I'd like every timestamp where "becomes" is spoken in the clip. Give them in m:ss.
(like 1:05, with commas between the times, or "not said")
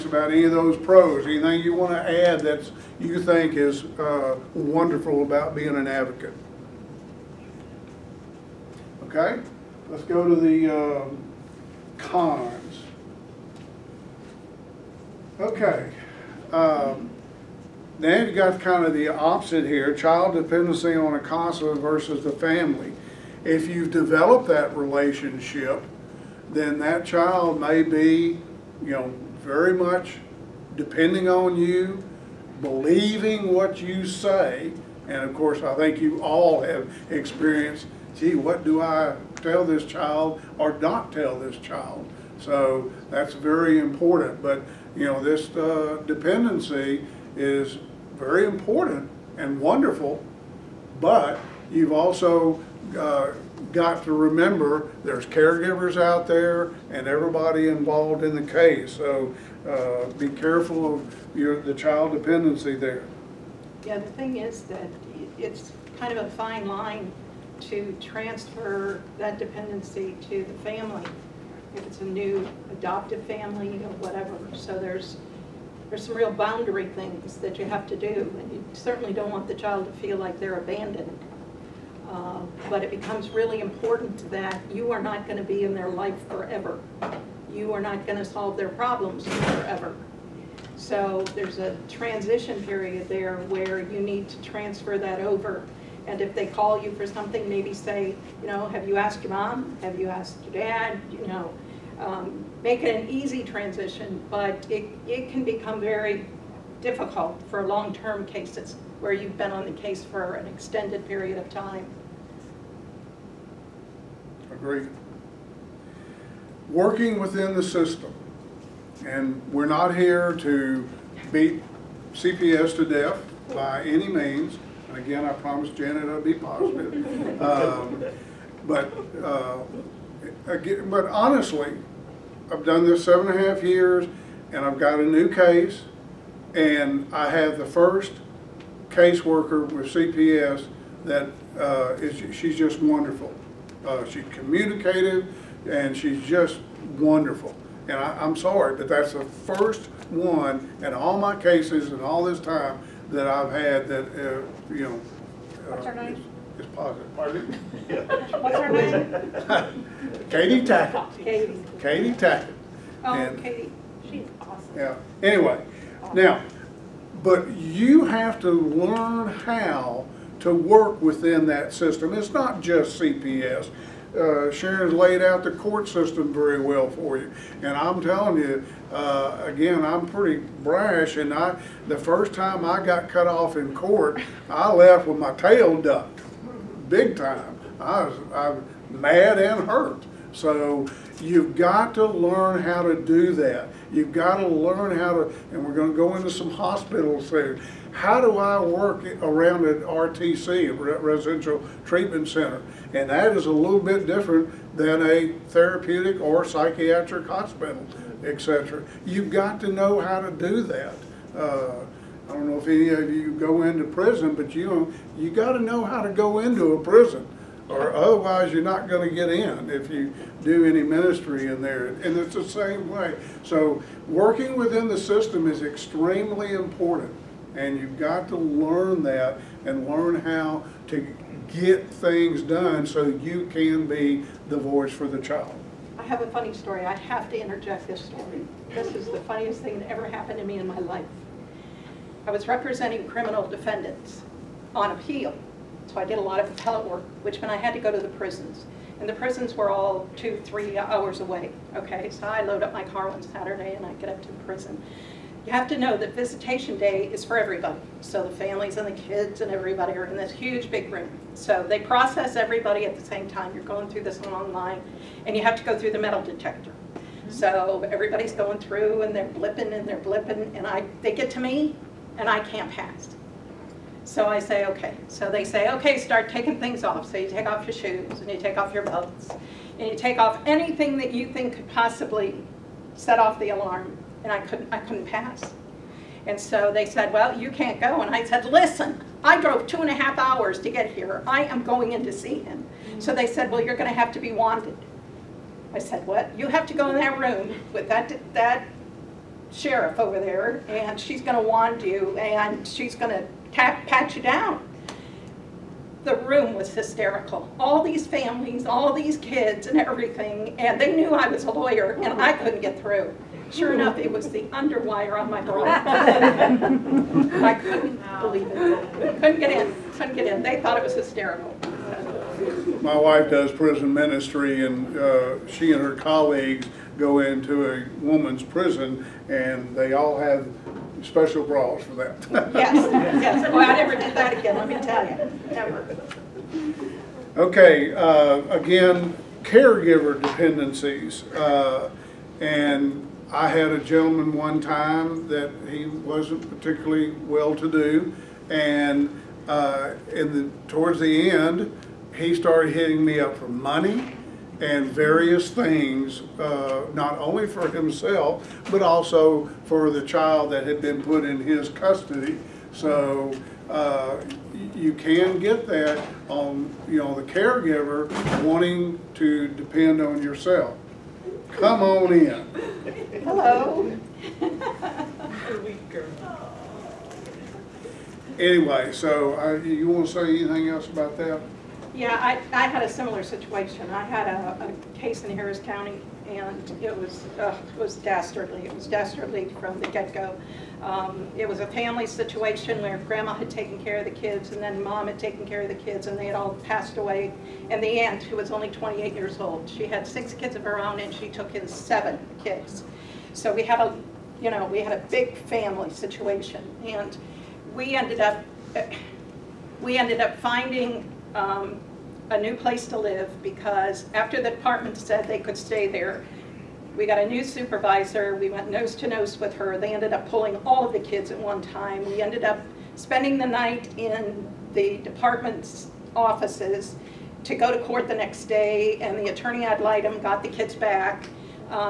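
1:22, 1:45.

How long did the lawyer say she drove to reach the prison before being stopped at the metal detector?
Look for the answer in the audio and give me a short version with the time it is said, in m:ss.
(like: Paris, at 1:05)
2.5 hours, at 4:49.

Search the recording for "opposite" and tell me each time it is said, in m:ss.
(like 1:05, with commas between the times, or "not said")
0:19.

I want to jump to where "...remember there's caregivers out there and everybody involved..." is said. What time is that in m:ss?
0:54.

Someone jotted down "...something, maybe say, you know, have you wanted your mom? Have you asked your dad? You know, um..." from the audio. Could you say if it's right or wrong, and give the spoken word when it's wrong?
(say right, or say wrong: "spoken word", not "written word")
wrong: "asked", not "wanted".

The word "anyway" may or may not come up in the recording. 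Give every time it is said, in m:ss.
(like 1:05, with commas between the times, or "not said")
2:45, 6:18.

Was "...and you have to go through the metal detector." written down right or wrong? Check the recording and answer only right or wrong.
right.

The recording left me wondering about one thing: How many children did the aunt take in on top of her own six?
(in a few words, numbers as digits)
7.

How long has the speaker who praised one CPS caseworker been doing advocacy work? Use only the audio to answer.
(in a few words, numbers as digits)
7.5 years.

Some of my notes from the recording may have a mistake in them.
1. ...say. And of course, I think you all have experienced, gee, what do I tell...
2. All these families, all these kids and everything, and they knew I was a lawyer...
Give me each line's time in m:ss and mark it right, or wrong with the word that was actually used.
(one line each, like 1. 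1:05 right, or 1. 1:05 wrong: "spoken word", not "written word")
1. 0:34 right
2. 5:07 right.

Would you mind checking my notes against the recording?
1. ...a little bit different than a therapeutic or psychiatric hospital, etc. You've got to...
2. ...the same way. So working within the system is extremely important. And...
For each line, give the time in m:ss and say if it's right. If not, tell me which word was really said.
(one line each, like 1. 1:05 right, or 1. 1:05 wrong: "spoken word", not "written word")
1. 3:23 right
2. 3:42 right.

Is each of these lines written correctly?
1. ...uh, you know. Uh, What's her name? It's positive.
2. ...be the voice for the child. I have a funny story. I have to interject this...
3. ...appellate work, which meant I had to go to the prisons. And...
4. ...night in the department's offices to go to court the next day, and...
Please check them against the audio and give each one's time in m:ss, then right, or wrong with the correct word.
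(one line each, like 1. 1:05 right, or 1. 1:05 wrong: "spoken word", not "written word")
1. 2:34 right
2. 3:53 right
3. 4:06 right
4. 7:03 right.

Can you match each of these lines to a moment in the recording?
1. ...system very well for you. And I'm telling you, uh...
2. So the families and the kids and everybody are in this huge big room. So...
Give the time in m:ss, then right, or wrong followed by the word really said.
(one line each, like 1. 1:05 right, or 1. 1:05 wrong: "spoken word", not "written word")
1. 2:55 right
2. 4:18 right.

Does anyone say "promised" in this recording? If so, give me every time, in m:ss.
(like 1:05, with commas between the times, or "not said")
2:05.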